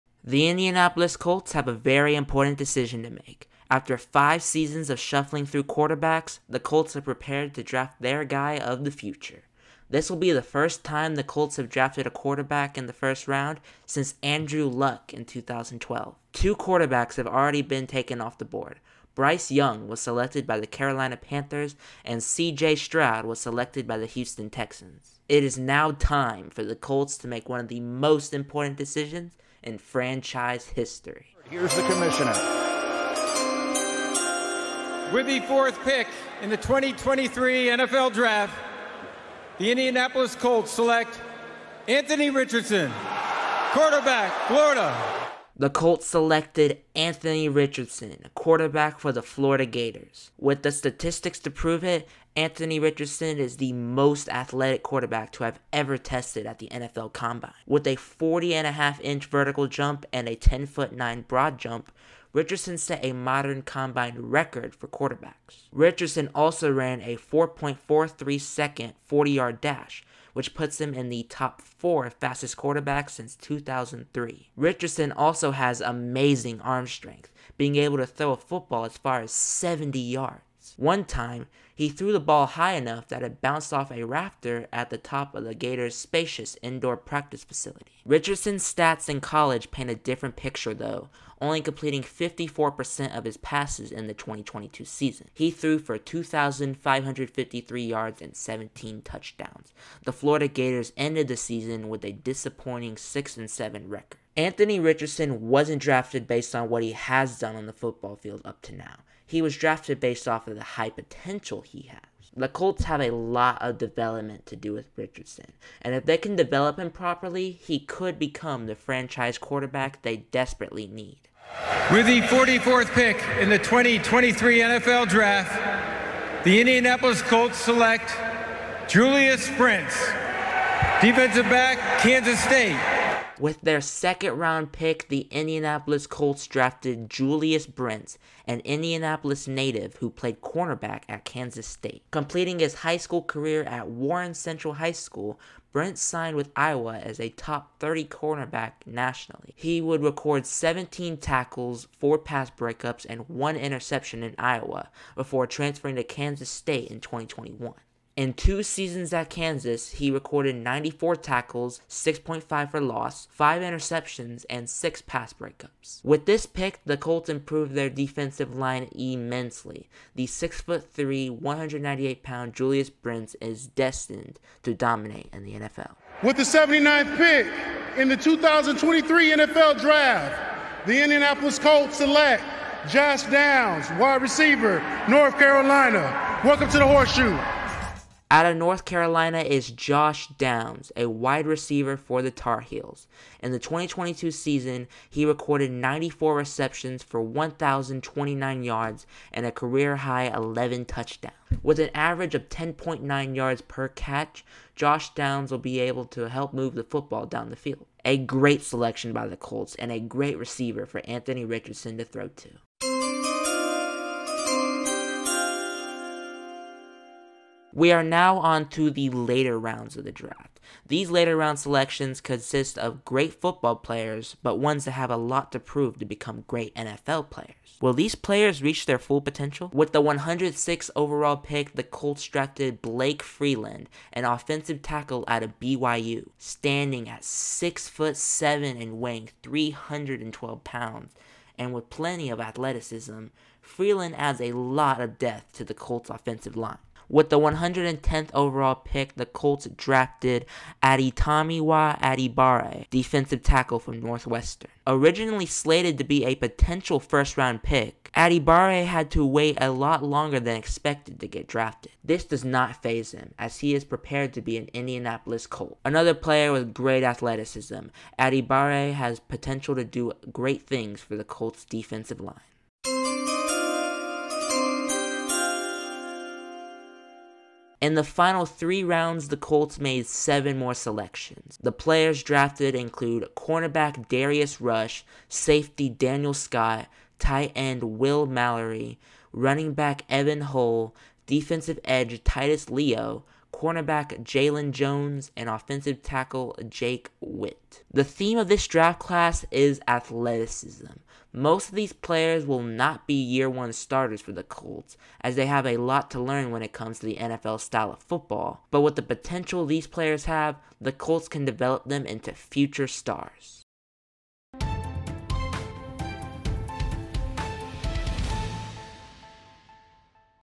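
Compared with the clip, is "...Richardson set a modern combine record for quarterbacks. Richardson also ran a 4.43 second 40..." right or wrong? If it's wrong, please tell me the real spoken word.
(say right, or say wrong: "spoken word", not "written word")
right.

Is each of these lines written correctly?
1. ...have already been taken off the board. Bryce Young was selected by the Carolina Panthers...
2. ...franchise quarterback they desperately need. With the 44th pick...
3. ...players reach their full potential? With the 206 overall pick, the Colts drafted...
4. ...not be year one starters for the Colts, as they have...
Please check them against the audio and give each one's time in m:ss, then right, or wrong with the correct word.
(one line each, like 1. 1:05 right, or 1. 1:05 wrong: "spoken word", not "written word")
1. 0:17 right
2. 1:58 right
3. 3:48 wrong: "106", not "206"
4. 5:02 right.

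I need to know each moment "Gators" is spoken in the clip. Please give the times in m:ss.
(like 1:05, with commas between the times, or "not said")
0:49, 1:25, 1:40.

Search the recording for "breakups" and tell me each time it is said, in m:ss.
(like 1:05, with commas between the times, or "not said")
2:32, 2:45.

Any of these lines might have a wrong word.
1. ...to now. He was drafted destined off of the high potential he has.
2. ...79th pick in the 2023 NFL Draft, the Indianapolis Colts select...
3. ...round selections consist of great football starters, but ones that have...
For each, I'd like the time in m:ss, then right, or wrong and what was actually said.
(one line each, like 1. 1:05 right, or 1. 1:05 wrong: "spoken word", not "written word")
1. 1:48 wrong: "based", not "destined"
2. 2:56 right
3. 3:41 wrong: "players", not "starters".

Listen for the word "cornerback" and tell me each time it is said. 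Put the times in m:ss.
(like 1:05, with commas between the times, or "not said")
2:20, 2:28, 4:43, 4:53.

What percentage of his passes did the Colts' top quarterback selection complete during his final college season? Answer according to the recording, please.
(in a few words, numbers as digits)
54%.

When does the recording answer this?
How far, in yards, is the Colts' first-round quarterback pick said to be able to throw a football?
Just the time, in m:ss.
1:19.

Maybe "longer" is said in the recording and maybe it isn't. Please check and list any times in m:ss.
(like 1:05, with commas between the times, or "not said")
4:20.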